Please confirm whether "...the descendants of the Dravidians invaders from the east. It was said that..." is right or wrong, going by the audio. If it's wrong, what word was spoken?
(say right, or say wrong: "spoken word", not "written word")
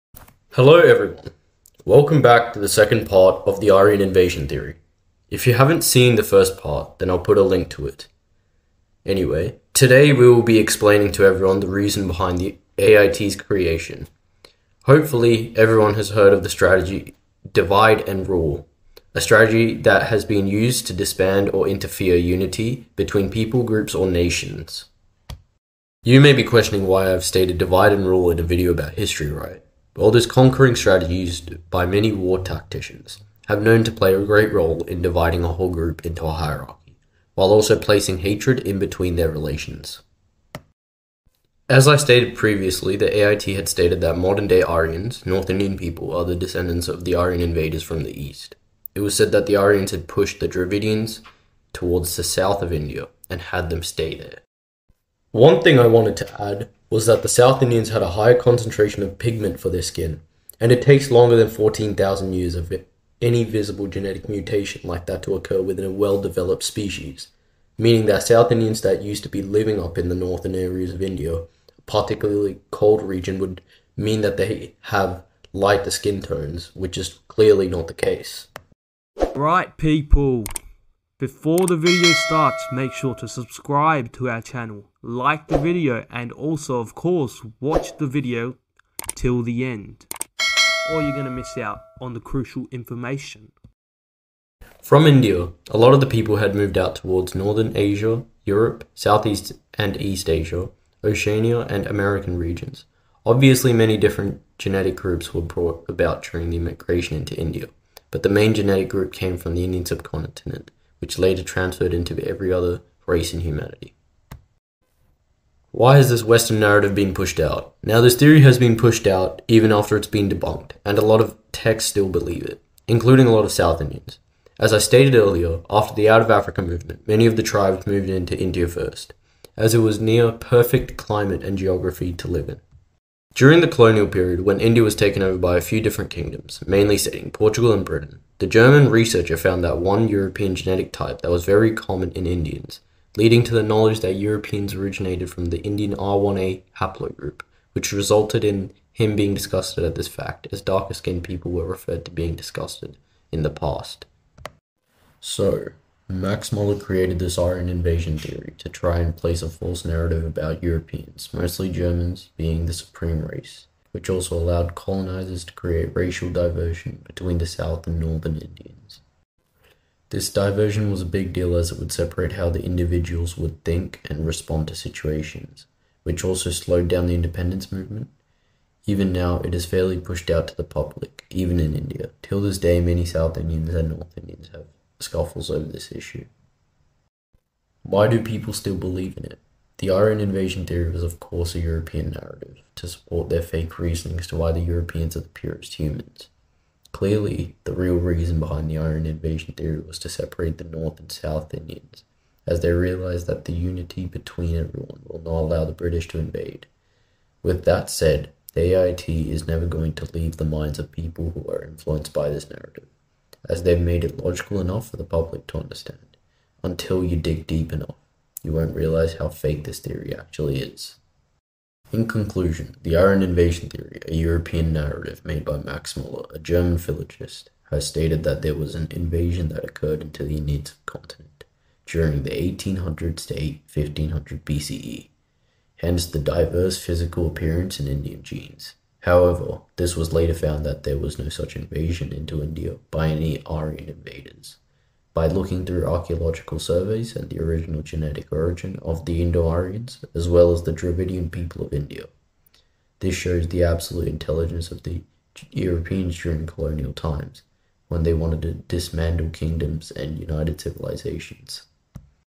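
wrong: "Aryan", not "Dravidians".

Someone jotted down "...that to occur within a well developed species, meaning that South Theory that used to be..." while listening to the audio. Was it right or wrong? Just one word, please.
wrong.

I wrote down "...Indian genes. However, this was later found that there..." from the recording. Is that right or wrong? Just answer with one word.
right.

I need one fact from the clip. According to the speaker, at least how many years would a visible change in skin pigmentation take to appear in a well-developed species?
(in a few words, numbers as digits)
14,000.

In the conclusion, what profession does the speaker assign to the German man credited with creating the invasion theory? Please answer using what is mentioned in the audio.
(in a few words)
Philologist.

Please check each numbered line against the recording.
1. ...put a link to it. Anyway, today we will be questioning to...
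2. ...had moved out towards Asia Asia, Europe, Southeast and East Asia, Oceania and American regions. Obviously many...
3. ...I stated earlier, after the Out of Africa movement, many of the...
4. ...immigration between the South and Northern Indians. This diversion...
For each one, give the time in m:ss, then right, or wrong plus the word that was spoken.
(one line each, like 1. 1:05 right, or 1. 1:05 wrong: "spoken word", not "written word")
1. 0:07 wrong: "explaining", not "questioning"
2. 1:36 wrong: "Northern", not "Asia"
3. 2:04 right
4. 2:46 wrong: "diversion", not "immigration".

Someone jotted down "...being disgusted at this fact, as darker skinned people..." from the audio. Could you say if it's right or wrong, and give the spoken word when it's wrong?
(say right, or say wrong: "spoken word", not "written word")
right.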